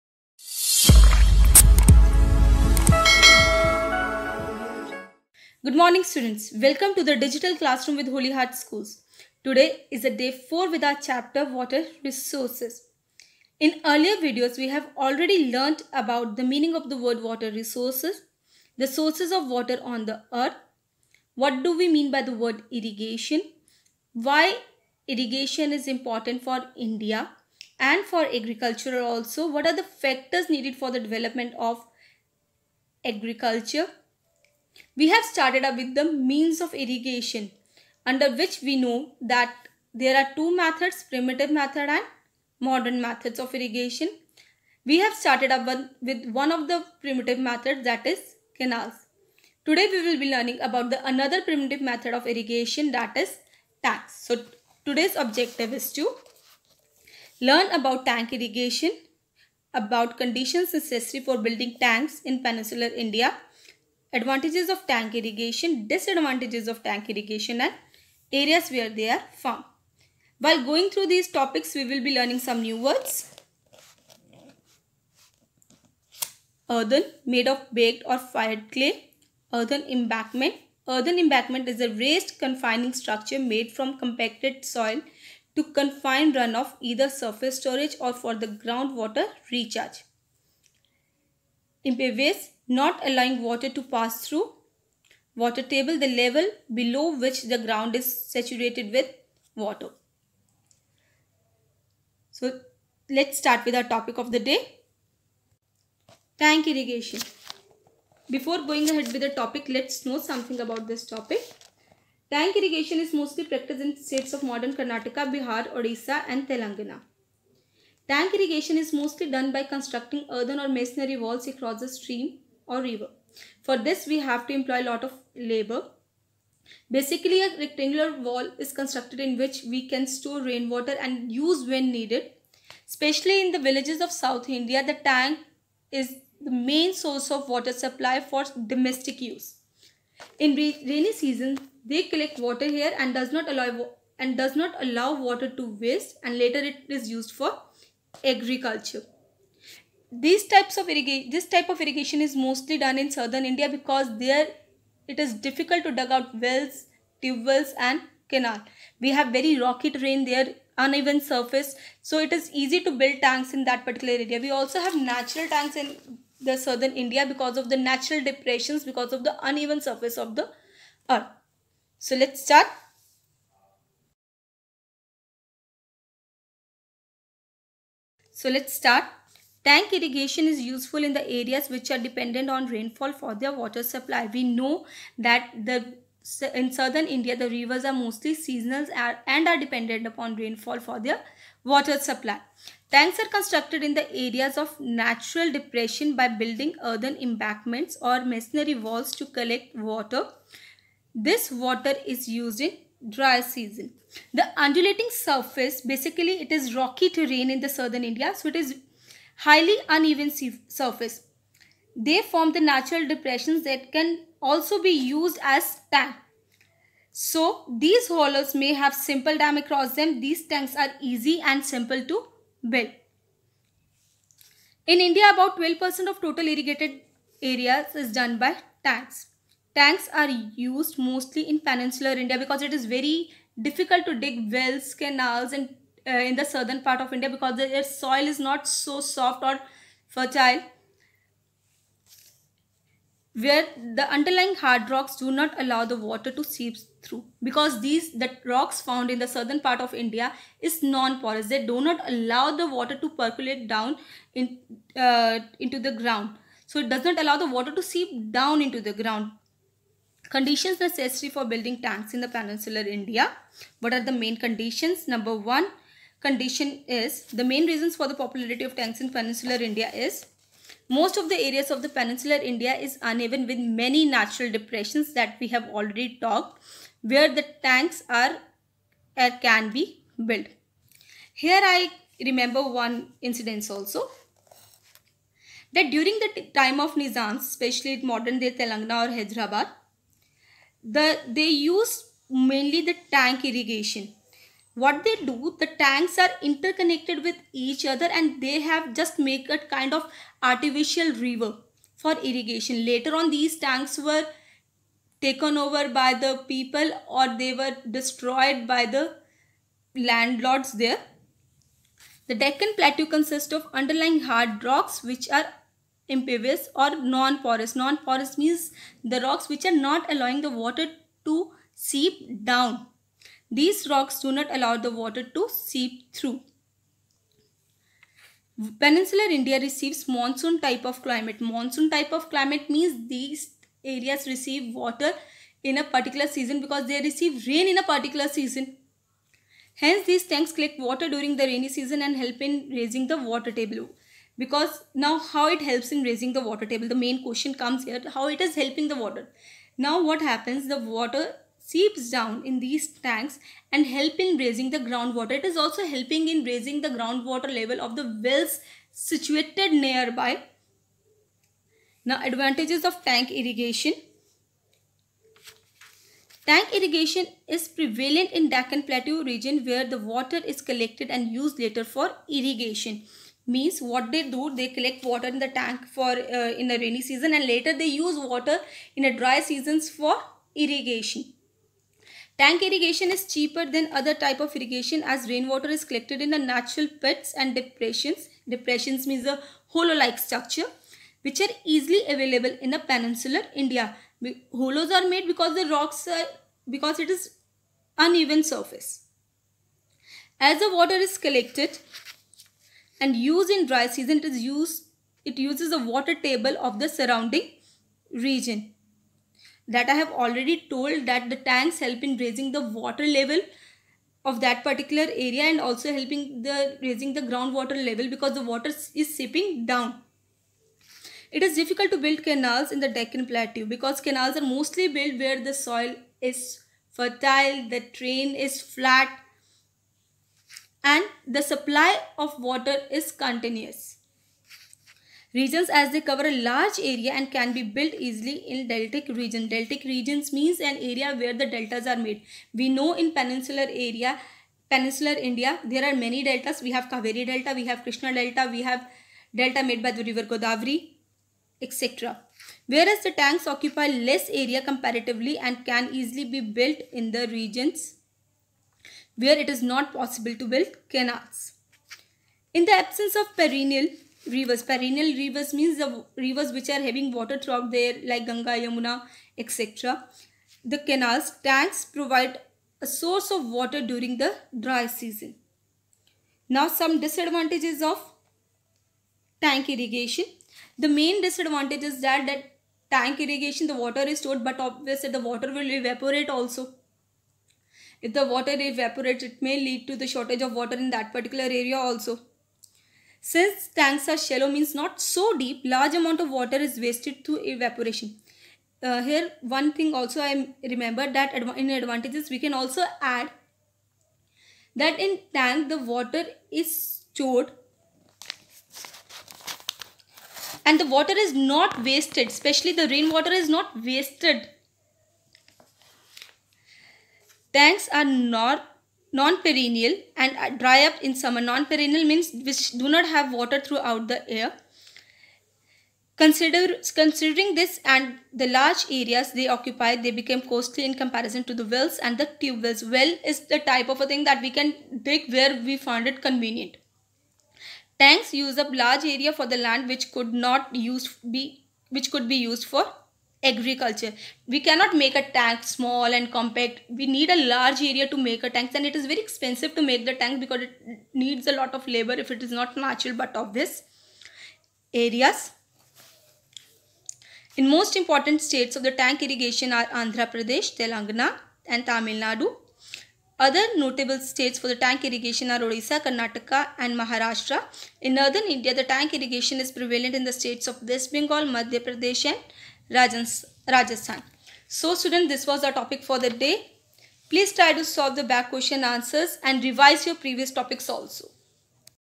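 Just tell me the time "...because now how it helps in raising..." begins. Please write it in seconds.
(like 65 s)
344 s.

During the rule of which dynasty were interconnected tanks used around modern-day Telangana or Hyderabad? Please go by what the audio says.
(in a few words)
Nizams.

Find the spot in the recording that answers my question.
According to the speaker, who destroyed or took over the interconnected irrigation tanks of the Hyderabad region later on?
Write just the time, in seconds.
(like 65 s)
309 s.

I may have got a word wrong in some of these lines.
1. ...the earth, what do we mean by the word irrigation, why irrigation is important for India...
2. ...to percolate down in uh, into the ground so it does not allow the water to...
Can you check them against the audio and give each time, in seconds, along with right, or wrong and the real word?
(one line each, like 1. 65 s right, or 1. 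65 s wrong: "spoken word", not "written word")
1. 20 s right
2. 252 s right.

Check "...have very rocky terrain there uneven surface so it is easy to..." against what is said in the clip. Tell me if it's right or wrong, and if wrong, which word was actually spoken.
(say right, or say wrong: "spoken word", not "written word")
right.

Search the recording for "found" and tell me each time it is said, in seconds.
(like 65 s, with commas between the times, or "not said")
69 s, 248 s.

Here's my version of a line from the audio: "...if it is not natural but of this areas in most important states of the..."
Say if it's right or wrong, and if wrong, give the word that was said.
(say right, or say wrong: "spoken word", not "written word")
right.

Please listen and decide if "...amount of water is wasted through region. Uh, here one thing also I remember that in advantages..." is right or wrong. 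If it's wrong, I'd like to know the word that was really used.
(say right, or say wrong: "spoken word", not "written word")
wrong: "evaporation", not "region".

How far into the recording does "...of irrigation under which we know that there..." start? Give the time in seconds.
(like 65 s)
36 s.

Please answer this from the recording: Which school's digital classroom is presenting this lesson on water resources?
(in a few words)
Holy Heart Schools.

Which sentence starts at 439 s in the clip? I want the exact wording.
Deltic regions means an area where the deltas are made.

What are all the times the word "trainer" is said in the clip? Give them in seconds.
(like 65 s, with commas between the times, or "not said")
not said.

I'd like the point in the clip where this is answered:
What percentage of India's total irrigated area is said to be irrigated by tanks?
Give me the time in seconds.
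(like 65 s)
225 s.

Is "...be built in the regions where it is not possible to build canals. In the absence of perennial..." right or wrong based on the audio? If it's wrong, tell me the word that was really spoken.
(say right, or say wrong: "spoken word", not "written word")
right.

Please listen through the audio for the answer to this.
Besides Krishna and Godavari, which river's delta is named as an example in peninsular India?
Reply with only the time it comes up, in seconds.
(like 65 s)
446 s.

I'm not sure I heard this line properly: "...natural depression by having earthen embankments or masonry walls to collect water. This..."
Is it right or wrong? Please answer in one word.
wrong.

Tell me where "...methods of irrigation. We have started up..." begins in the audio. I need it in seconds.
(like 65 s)
43 s.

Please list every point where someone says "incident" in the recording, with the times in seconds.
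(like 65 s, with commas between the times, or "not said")
283 s.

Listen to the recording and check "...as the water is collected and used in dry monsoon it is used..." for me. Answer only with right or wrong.
wrong.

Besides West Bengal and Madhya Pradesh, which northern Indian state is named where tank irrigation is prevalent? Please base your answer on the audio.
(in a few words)
Rajasthan.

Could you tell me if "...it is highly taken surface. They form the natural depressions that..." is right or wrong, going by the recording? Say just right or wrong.
wrong.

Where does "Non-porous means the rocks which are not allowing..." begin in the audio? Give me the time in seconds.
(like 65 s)
317 s.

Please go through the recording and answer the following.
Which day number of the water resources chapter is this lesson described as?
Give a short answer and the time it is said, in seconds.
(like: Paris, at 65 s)
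Day 4, at 10 s.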